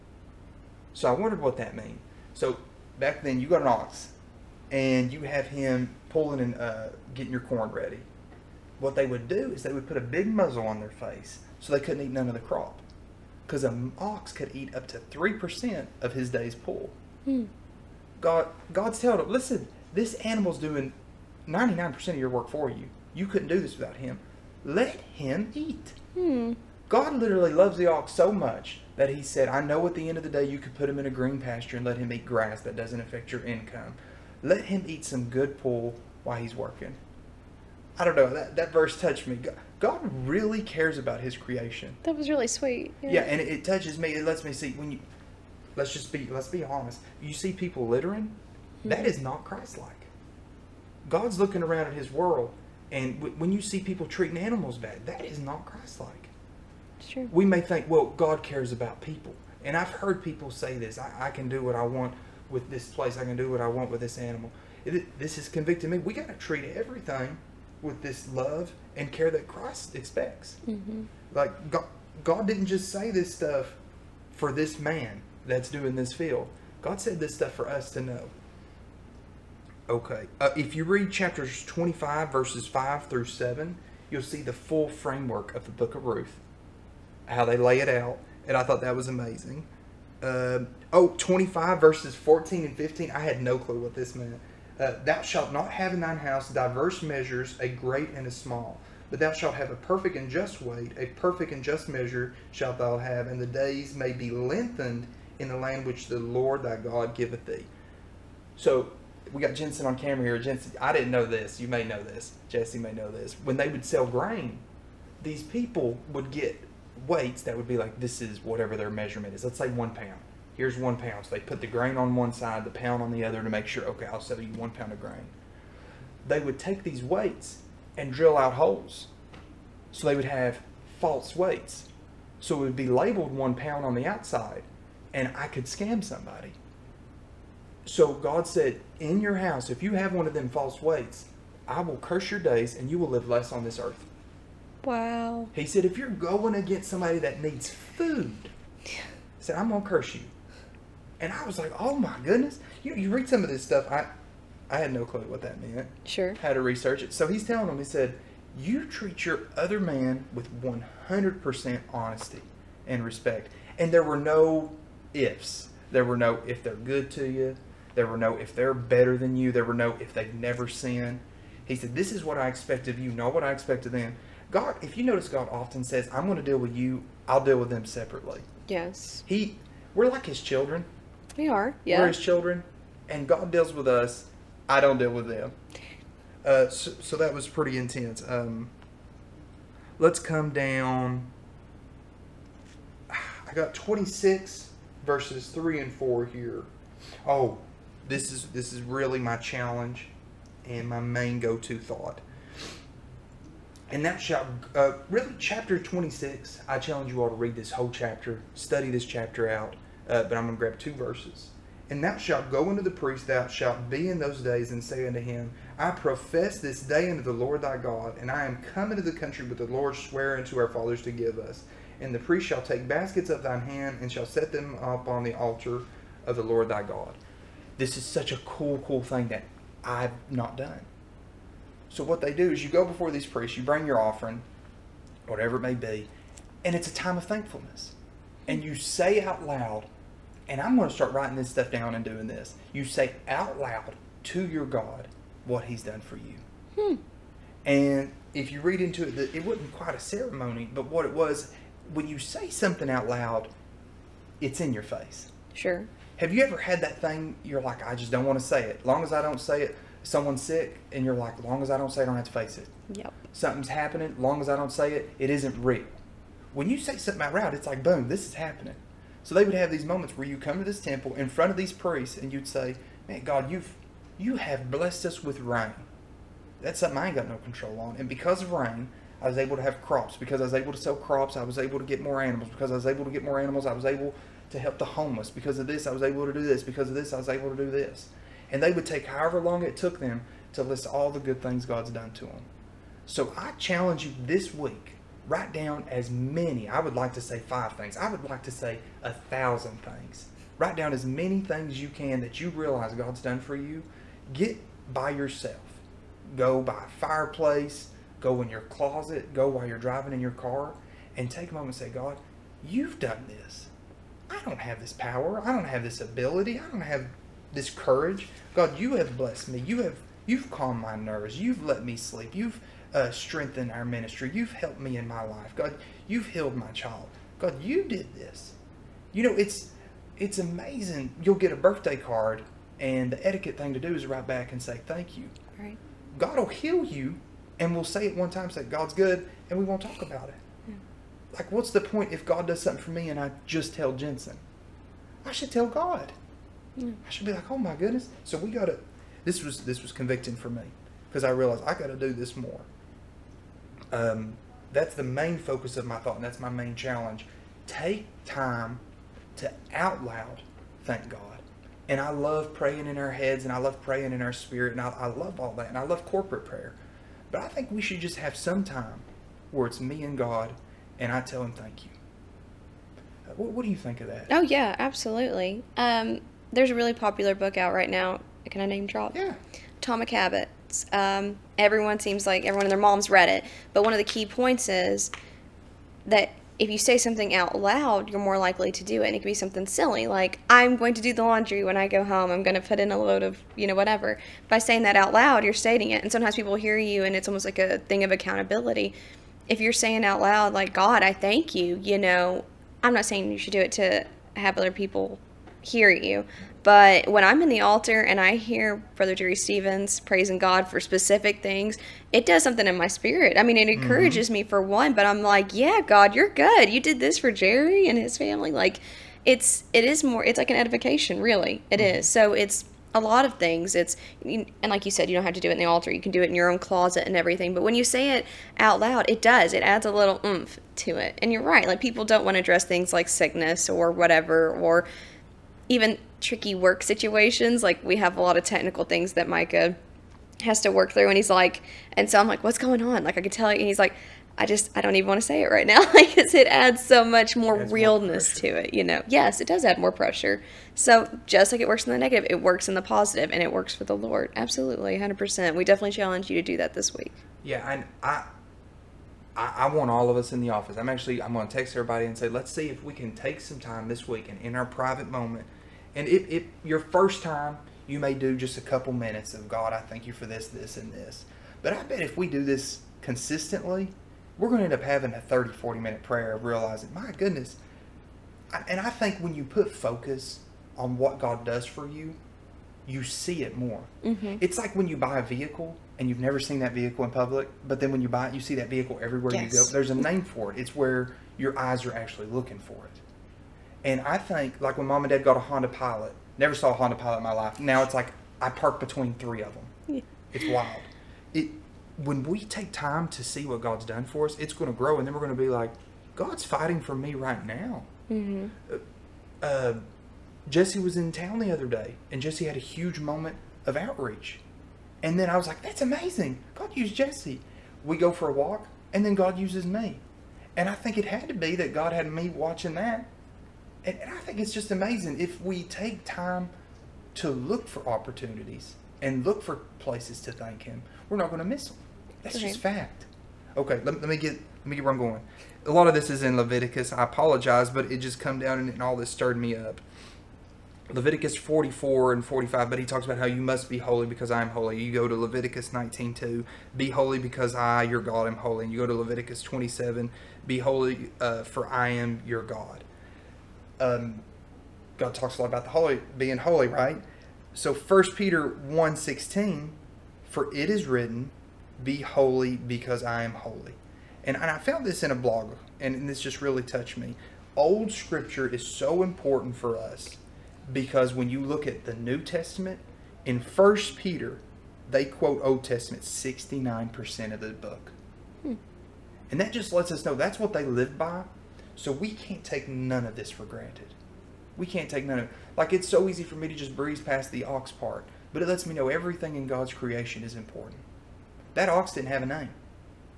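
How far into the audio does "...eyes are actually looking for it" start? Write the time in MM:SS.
08:11.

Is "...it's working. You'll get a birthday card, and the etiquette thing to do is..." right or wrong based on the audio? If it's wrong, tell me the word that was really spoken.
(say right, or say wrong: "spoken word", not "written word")
wrong: "amazing", not "working".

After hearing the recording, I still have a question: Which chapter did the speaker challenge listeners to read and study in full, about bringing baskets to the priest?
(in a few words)
Chapter 26.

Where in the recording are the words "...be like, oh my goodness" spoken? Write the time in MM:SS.
05:47.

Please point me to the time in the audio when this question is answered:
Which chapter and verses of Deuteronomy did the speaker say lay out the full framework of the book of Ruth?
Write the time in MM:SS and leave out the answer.
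01:21.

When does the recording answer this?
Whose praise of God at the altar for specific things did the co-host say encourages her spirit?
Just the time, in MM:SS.
06:48.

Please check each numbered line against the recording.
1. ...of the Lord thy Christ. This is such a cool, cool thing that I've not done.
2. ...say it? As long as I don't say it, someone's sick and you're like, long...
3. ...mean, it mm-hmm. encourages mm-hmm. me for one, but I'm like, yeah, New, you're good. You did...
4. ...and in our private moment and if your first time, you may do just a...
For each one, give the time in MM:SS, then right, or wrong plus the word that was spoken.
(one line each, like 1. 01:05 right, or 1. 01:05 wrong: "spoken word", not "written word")
1. 03:46 wrong: "God", not "Christ"
2. 04:18 right
3. 06:53 wrong: "God", not "New"
4. 07:44 right.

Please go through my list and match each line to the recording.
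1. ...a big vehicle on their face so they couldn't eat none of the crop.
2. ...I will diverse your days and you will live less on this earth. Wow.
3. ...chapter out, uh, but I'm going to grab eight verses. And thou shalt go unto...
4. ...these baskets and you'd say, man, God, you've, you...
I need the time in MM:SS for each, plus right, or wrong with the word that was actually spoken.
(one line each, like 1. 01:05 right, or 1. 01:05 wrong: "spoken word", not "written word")
1. 00:09 wrong: "muzzle", not "vehicle"
2. 02:21 wrong: "curse", not "diverse"
3. 03:29 wrong: "two", not "eight"
4. 04:31 wrong: "priests", not "baskets".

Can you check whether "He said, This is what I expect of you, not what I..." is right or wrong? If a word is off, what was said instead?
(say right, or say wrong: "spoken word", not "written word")
right.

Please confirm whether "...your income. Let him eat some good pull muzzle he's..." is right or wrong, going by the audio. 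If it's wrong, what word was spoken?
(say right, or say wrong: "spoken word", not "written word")
wrong: "while", not "muzzle".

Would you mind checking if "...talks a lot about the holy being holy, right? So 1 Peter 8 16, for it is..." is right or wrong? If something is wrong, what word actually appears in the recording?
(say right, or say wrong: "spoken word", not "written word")
wrong: "1", not "8".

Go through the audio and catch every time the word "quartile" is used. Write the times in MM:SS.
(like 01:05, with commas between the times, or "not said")
not said.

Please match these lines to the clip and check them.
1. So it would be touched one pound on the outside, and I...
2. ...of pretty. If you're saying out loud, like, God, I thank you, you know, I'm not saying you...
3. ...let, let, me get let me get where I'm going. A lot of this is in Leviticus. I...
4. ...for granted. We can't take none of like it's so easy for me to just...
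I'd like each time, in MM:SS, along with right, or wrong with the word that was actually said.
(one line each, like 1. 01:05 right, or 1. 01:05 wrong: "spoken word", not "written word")
1. 02:12 wrong: "labeled", not "touched"
2. 06:38 wrong: "accountability", not "pretty"
3. 08:53 right
4. 09:43 right.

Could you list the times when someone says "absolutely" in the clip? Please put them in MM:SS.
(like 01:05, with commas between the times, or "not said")
06:14, 07:34.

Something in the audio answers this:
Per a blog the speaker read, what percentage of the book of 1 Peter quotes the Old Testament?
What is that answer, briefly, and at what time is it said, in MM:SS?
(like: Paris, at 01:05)
69%, at 09:36.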